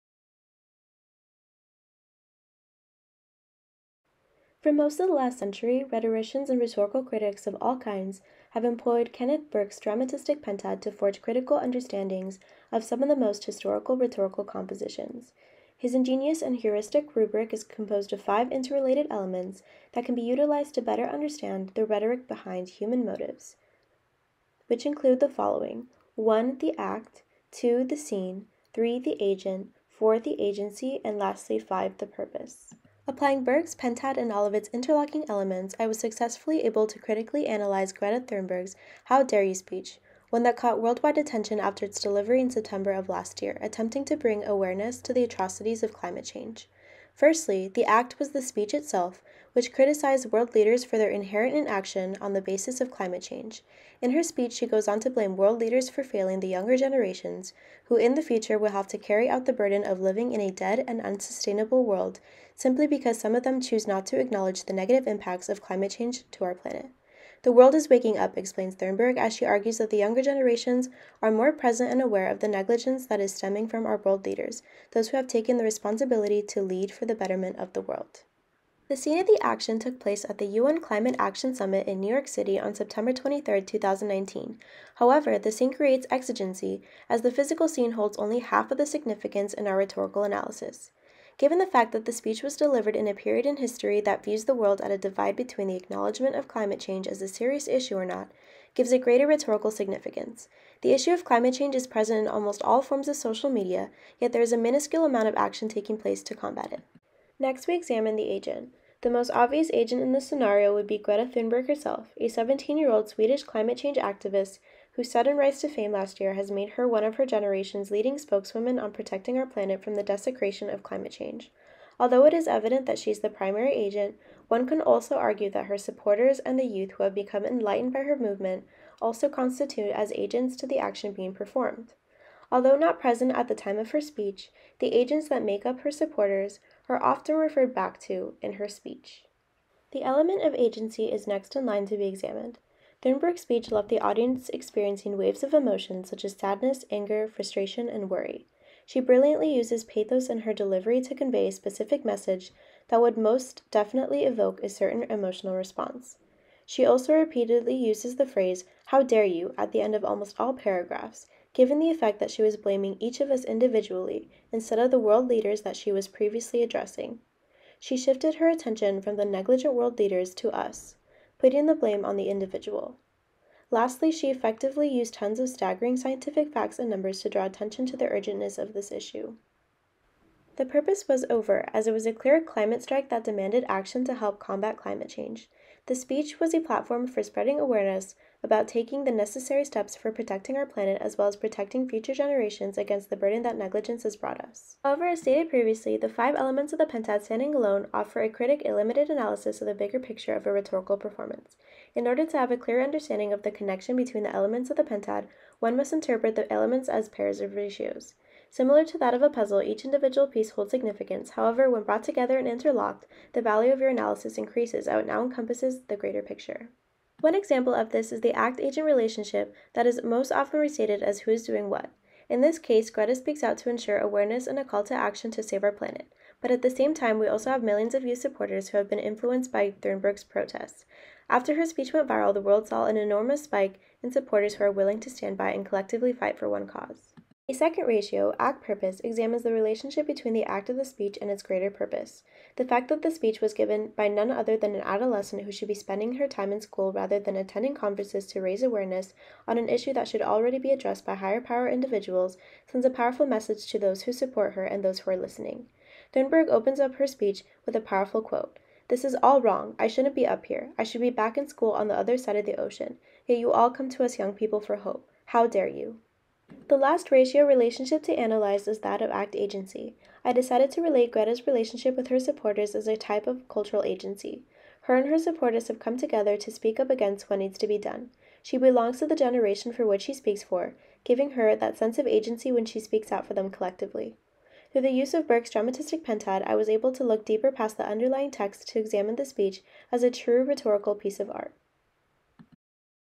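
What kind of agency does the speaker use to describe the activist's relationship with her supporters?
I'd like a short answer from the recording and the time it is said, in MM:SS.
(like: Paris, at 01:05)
cultural agency, at 04:33.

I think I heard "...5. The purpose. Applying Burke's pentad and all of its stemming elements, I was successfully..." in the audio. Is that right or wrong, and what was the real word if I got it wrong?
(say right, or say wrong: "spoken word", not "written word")
wrong: "interlocking", not "stemming".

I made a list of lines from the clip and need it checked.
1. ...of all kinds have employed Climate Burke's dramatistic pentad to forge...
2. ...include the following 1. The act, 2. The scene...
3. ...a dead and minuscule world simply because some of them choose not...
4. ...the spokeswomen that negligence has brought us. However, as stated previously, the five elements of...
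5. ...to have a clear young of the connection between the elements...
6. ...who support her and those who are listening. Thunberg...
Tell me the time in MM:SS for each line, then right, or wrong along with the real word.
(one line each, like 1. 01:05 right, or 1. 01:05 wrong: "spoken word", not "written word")
1. 00:07 wrong: "Kenneth", not "Climate"
2. 00:24 right
3. 01:00 wrong: "unsustainable", not "minuscule"
4. 03:13 wrong: "burden", not "spokeswomen"
5. 03:22 wrong: "understanding", not "young"
6. 04:14 right.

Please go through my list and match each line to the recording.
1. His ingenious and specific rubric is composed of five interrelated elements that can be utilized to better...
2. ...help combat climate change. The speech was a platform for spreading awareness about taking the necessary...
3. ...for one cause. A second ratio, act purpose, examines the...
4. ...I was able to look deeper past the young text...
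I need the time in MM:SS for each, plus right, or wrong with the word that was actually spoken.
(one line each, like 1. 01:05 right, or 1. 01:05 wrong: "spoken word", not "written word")
1. 00:15 wrong: "heuristic", not "specific"
2. 03:04 right
3. 03:56 right
4. 04:46 wrong: "underlying", not "young".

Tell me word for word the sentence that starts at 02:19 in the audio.
The element of agency is next in line to be examined.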